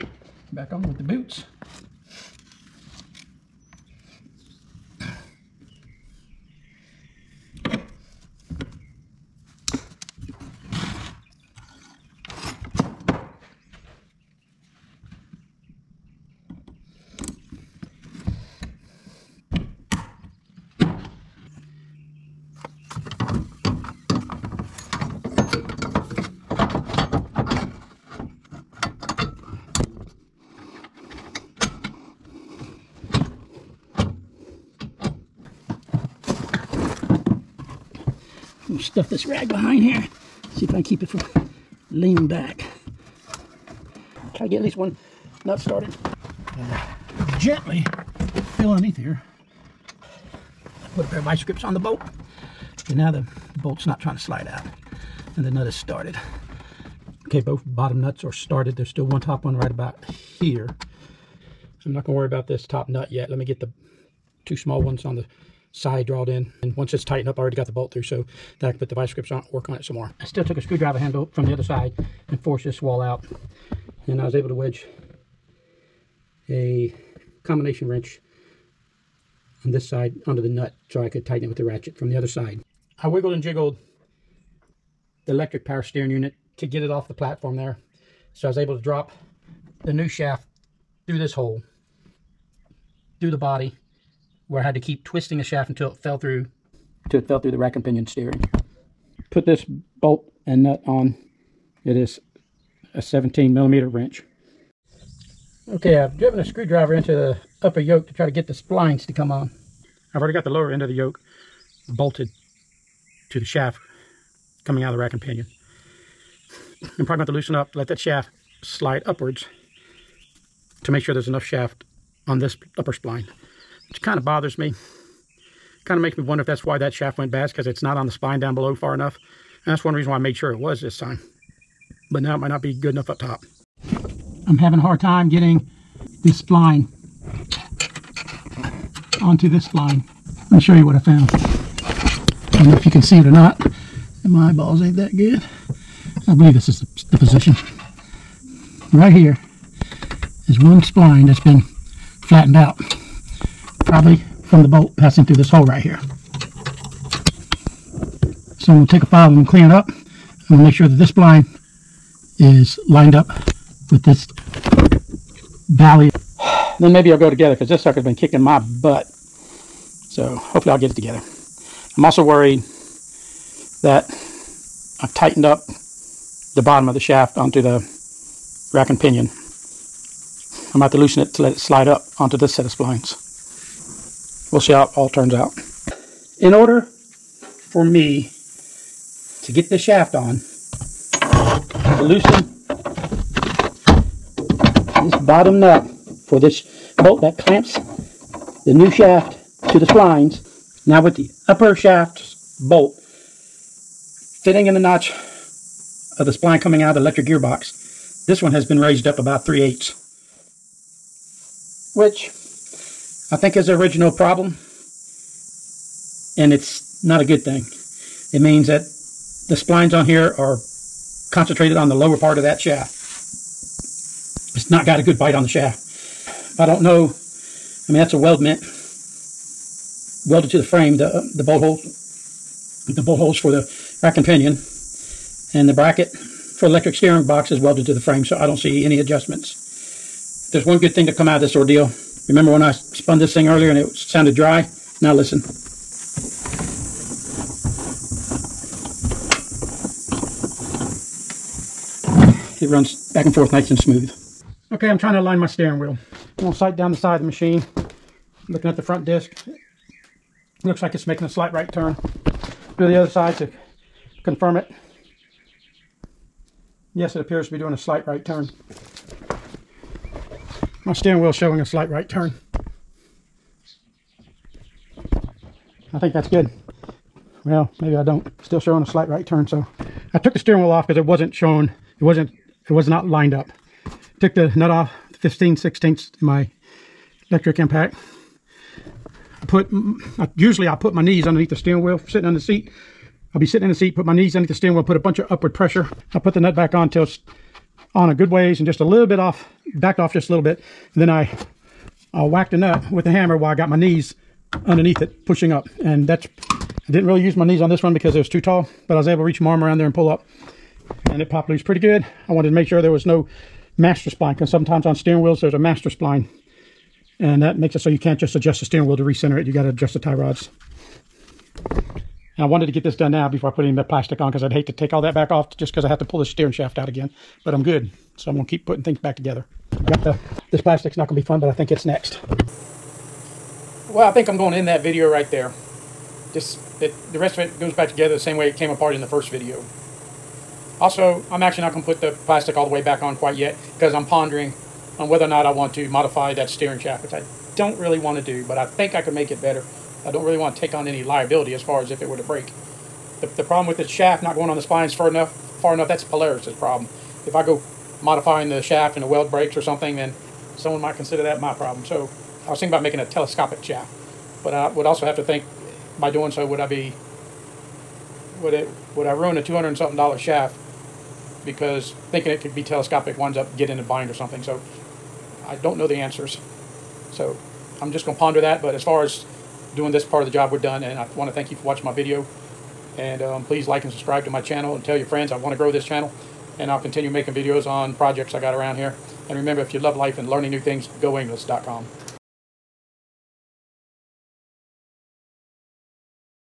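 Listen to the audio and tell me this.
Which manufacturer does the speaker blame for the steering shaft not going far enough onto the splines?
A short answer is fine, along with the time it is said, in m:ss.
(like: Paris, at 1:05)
Polaris, at 5:56.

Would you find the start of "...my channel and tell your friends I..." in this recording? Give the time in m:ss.
6:24.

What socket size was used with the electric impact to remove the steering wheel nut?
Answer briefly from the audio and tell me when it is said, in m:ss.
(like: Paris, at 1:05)
15/16, at 4:45.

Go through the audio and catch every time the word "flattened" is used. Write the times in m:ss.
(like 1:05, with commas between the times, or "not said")
2:32.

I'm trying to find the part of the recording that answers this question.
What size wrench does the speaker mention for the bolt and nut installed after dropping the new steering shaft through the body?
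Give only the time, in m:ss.
1:43.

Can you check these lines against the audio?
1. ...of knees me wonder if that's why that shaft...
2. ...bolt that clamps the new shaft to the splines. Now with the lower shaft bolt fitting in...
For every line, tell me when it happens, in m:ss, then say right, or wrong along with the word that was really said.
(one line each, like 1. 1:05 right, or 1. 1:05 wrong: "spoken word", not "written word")
1. 2:05 wrong: "makes", not "knees"
2. 3:16 wrong: "upper", not "lower".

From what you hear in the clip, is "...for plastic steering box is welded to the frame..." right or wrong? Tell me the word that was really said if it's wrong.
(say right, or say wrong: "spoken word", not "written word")
wrong: "electric", not "plastic".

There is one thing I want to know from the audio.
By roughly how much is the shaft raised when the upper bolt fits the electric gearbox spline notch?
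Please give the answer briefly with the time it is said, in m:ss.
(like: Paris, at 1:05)
3/8, at 3:29.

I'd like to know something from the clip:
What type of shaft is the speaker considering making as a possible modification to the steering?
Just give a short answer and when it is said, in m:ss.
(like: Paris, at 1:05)
telescopic shaft, at 6:03.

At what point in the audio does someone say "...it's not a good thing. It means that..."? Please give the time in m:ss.
3:36.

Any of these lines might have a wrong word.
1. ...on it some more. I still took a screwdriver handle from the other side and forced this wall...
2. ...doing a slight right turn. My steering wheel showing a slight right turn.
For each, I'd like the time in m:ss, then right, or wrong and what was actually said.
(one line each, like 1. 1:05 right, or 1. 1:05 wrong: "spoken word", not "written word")
1. 1:09 right
2. 4:27 right.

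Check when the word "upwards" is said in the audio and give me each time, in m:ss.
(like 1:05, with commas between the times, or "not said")
1:59, 4:55.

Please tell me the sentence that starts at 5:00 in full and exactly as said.
then I uh, whacked a nut with the hammer while I got my knees underneath it, pushing up.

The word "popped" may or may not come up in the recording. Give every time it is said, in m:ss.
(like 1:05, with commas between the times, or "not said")
5:11.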